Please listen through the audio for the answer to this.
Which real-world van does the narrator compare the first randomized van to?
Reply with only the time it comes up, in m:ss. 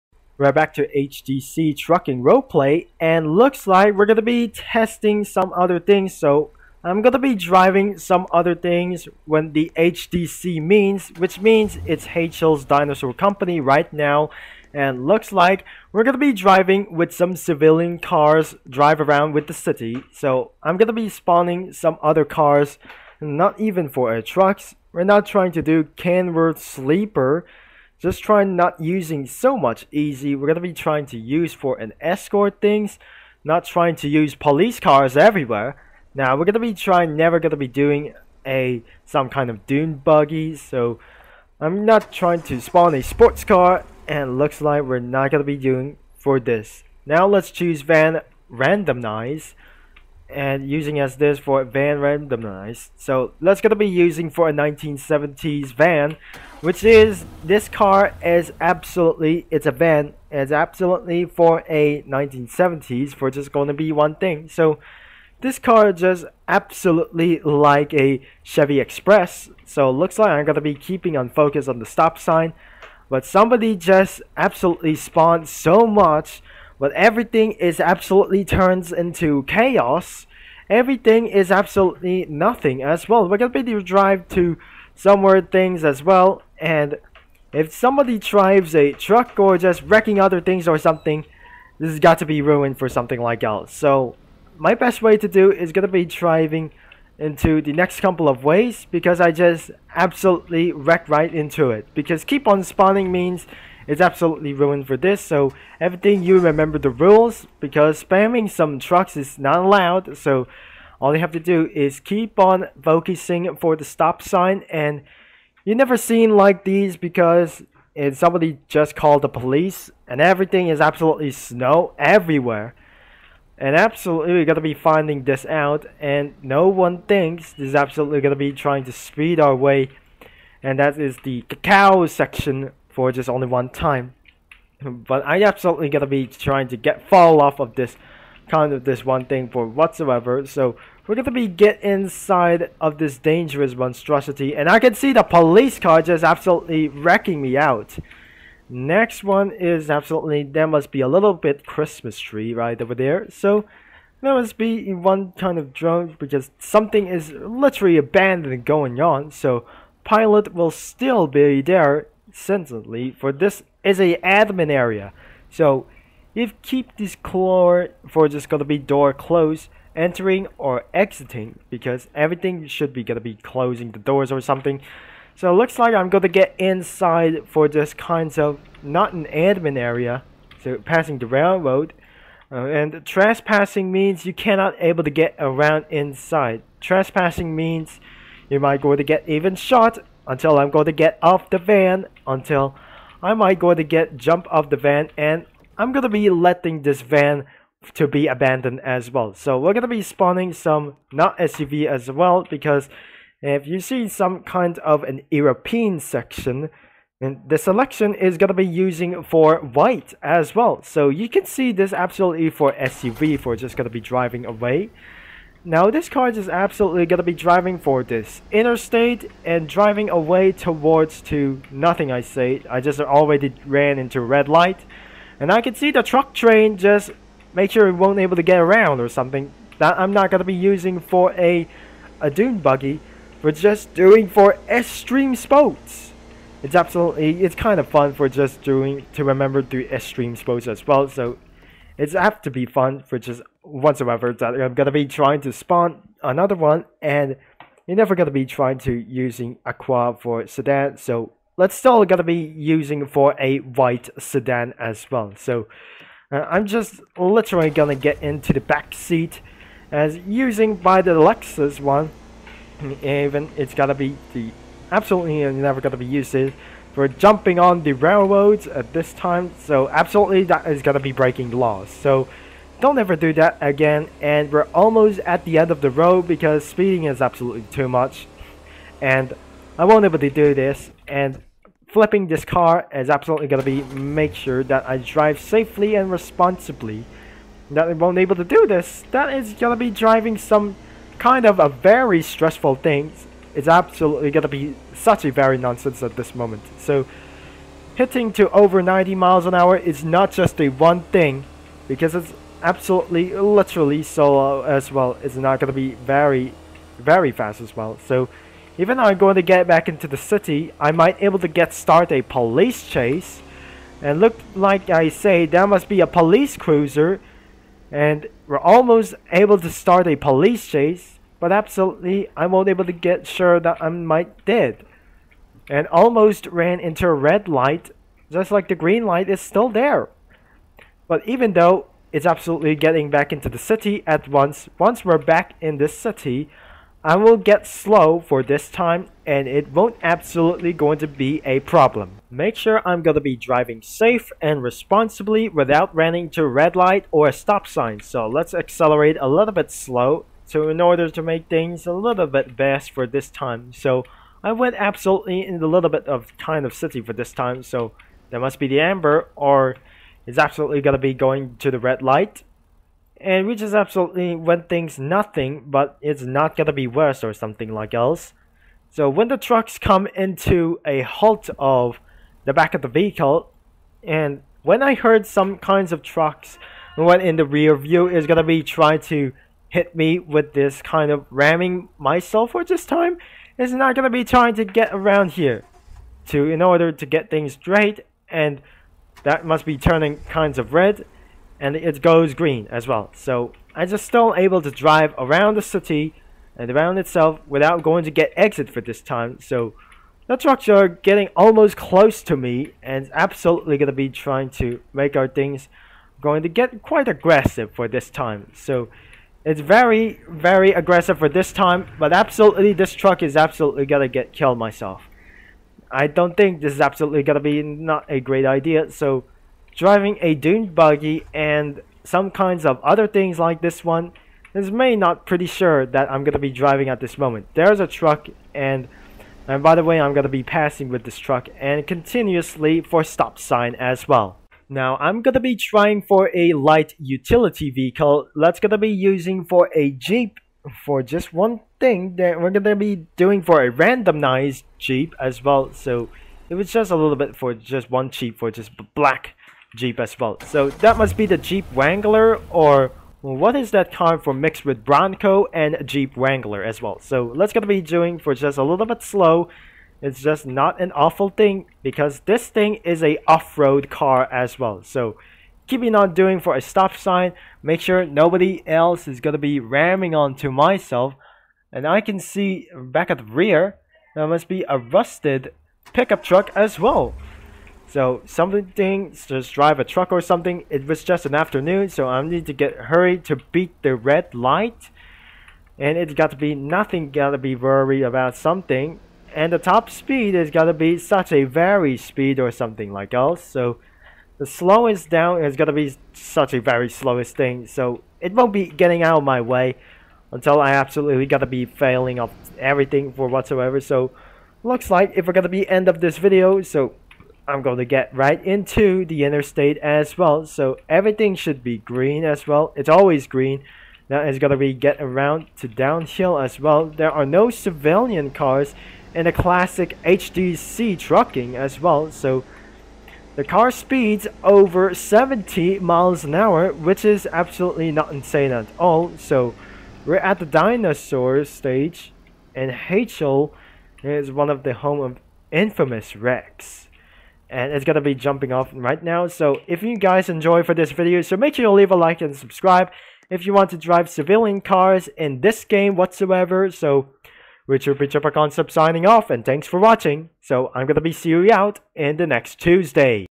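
1:08.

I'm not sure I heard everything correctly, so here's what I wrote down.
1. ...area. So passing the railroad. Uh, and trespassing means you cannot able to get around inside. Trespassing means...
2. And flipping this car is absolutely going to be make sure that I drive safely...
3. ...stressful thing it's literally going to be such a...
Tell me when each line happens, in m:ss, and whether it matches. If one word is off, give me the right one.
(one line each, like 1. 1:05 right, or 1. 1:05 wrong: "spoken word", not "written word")
1. 2:59 right
2. 4:41 right
3. 4:52 wrong: "absolutely", not "literally".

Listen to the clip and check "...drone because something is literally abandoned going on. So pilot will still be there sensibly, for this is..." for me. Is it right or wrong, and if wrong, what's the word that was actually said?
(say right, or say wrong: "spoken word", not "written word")
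right.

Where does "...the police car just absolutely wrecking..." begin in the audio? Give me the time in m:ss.
2:25.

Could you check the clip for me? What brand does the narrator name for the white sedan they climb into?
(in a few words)
Lexus.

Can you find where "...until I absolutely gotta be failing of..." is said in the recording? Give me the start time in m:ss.
8:20.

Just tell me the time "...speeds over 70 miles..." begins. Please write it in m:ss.
8:43.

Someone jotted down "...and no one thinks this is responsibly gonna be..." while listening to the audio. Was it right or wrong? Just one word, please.
wrong.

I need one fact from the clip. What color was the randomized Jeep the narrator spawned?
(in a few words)
black.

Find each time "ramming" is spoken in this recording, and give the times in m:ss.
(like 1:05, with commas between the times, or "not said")
6:21, 7:49.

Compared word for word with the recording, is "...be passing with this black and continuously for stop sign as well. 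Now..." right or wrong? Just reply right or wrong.
wrong.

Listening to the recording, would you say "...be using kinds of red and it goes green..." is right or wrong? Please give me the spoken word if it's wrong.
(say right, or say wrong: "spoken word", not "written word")
wrong: "turning", not "using".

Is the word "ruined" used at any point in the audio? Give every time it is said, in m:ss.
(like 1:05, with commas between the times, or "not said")
1:32, 1:44.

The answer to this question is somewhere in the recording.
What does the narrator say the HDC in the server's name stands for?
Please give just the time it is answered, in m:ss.
0:12.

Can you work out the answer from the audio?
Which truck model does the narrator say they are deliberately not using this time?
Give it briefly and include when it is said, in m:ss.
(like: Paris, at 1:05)
Kenworth Sleeper, at 0:25.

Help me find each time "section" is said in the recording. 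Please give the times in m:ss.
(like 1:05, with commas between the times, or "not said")
2:12, 3:25.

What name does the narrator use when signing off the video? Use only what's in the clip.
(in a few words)
Richard Pichapa Concept.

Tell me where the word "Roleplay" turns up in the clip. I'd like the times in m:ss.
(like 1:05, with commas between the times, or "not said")
0:02.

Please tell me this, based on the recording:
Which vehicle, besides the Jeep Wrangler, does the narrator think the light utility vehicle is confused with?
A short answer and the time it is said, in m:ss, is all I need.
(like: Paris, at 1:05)
Bronco, at 7:34.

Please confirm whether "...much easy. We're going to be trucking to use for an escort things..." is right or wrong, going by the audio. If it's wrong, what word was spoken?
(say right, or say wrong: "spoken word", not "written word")
wrong: "trying", not "trucking".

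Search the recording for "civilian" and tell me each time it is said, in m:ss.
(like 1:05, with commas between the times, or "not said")
0:17, 8:37, 9:04.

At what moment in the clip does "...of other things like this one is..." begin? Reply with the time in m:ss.
7:02.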